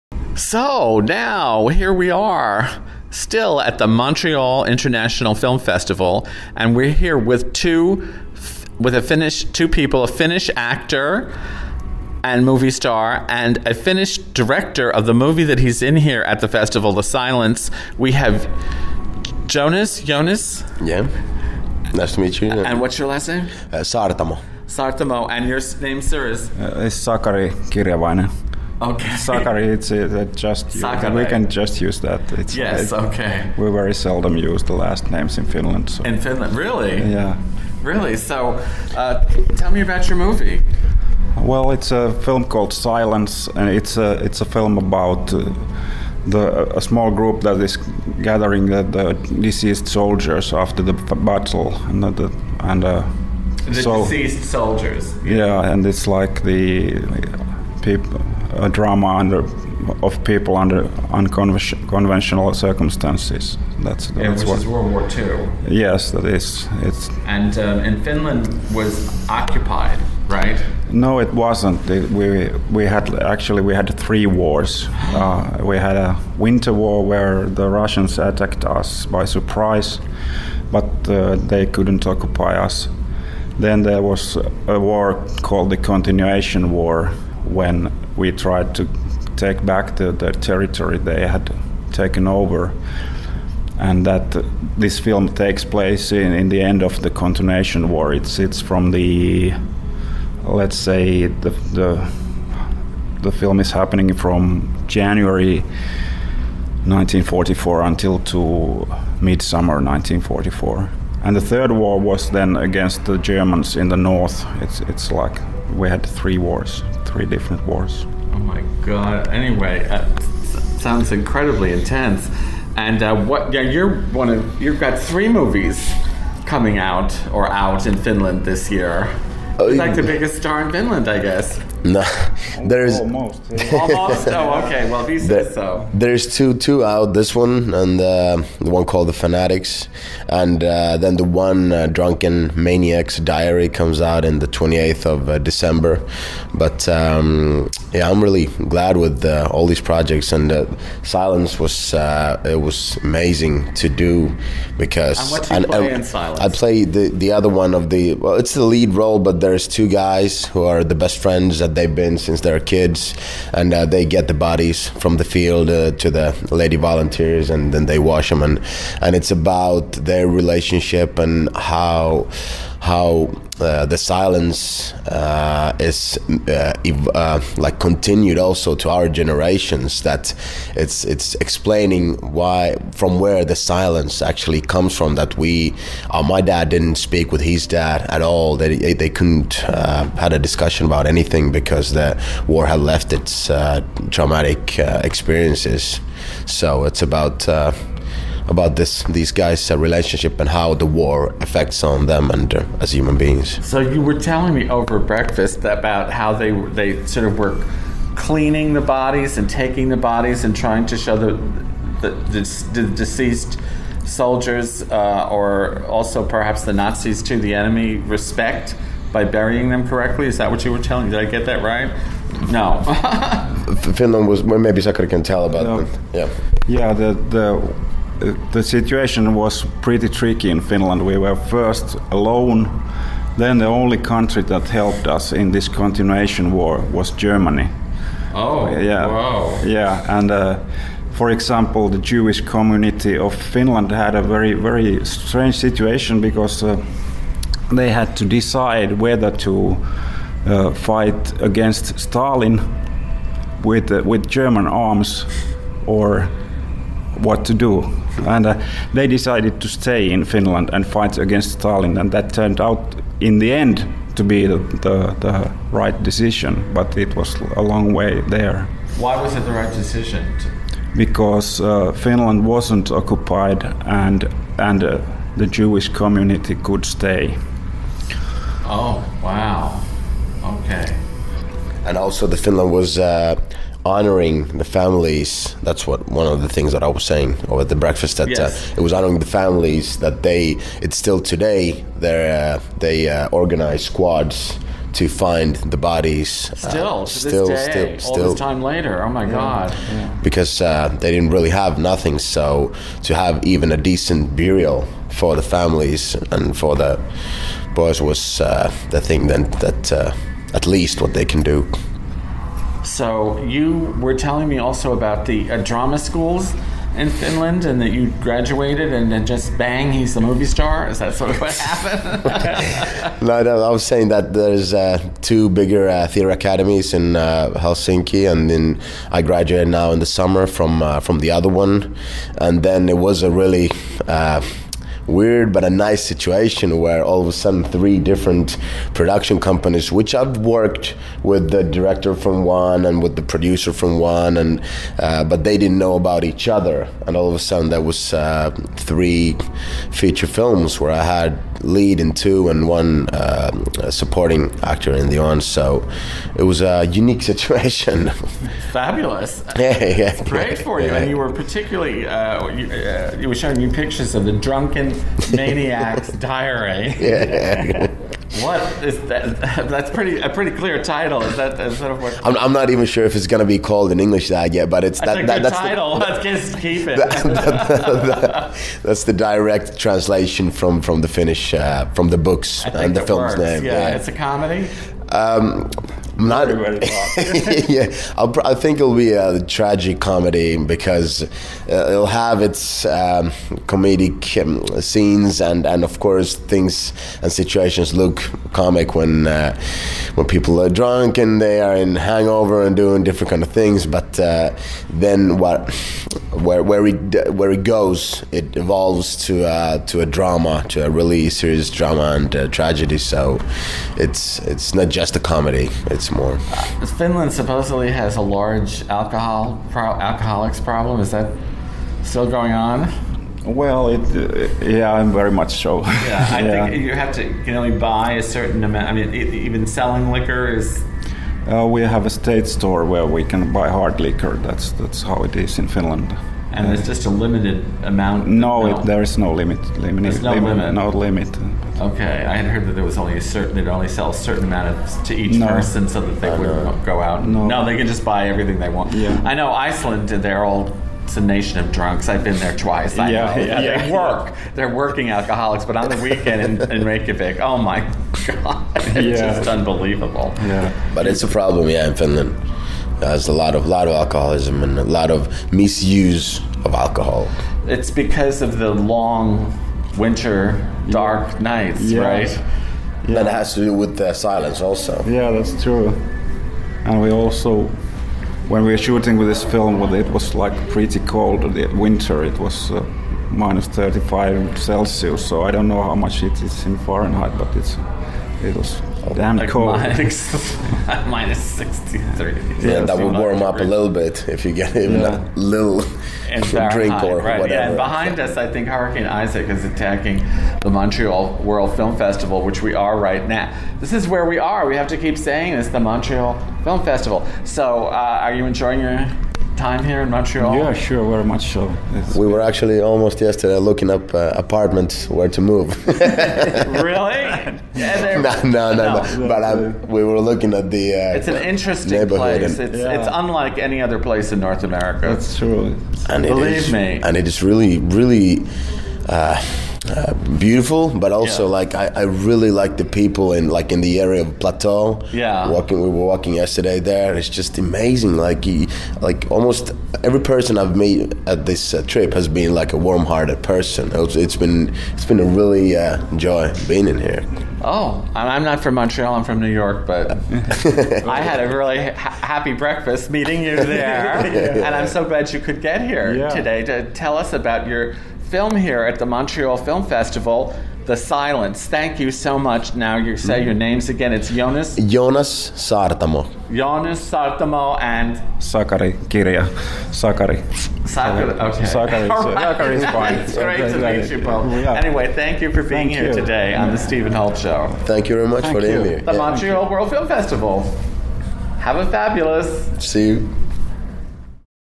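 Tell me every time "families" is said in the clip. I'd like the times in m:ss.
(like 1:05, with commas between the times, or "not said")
4:44, 4:49, 5:05.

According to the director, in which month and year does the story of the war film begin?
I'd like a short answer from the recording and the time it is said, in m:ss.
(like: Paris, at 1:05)
January 1944, at 1:44.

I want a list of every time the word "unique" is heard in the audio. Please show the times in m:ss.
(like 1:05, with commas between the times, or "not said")
5:56.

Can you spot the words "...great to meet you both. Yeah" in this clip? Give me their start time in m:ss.
9:33.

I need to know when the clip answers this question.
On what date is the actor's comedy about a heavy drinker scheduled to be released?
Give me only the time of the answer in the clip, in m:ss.
2:24.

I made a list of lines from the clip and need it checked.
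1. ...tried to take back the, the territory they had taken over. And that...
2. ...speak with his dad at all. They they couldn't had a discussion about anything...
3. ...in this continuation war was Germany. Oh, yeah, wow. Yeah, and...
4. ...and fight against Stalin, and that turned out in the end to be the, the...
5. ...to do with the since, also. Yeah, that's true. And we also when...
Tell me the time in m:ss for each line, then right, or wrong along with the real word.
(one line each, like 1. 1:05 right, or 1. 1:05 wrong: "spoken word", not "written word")
1. 1:28 right
2. 3:06 right
3. 3:55 right
4. 4:20 right
5. 7:53 wrong: "silence", not "since".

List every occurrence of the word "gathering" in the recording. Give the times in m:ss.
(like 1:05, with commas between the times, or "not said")
0:48.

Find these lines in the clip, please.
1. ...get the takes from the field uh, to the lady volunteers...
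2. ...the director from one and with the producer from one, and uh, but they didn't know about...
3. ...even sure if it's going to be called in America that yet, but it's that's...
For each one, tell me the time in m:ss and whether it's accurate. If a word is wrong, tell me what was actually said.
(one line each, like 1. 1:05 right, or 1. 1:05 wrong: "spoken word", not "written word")
1. 2:44 wrong: "bodies", not "takes"
2. 5:41 right
3. 6:12 wrong: "English", not "America".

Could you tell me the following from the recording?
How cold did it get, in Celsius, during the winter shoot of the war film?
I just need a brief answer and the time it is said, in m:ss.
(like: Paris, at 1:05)
minus 35 Celsius, at 8:03.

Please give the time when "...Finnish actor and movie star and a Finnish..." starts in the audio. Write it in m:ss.
0:10.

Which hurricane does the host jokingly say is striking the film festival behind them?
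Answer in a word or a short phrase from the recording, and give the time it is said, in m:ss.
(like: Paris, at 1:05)
Hurricane Isaac, at 8:18.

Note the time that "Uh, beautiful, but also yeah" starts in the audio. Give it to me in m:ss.
8:49.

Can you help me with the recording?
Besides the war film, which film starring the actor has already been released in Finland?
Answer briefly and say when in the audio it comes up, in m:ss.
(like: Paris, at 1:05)
The Fanatics, at 2:19.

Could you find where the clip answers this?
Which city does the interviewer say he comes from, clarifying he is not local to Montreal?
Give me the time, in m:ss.
9:09.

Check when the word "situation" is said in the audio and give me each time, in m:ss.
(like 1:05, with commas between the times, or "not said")
3:48, 4:05, 5:36, 5:57, 6:37.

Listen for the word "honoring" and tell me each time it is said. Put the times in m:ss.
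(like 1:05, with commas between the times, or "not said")
4:43, 4:48.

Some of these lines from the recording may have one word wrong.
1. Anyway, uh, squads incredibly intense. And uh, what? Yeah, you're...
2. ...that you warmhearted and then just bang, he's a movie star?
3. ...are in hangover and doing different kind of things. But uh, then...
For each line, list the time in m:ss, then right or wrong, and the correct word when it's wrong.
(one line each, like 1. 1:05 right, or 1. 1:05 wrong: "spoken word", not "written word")
1. 1:59 wrong: "sounds", not "squads"
2. 5:17 wrong: "graduated", not "warmhearted"
3. 6:41 right.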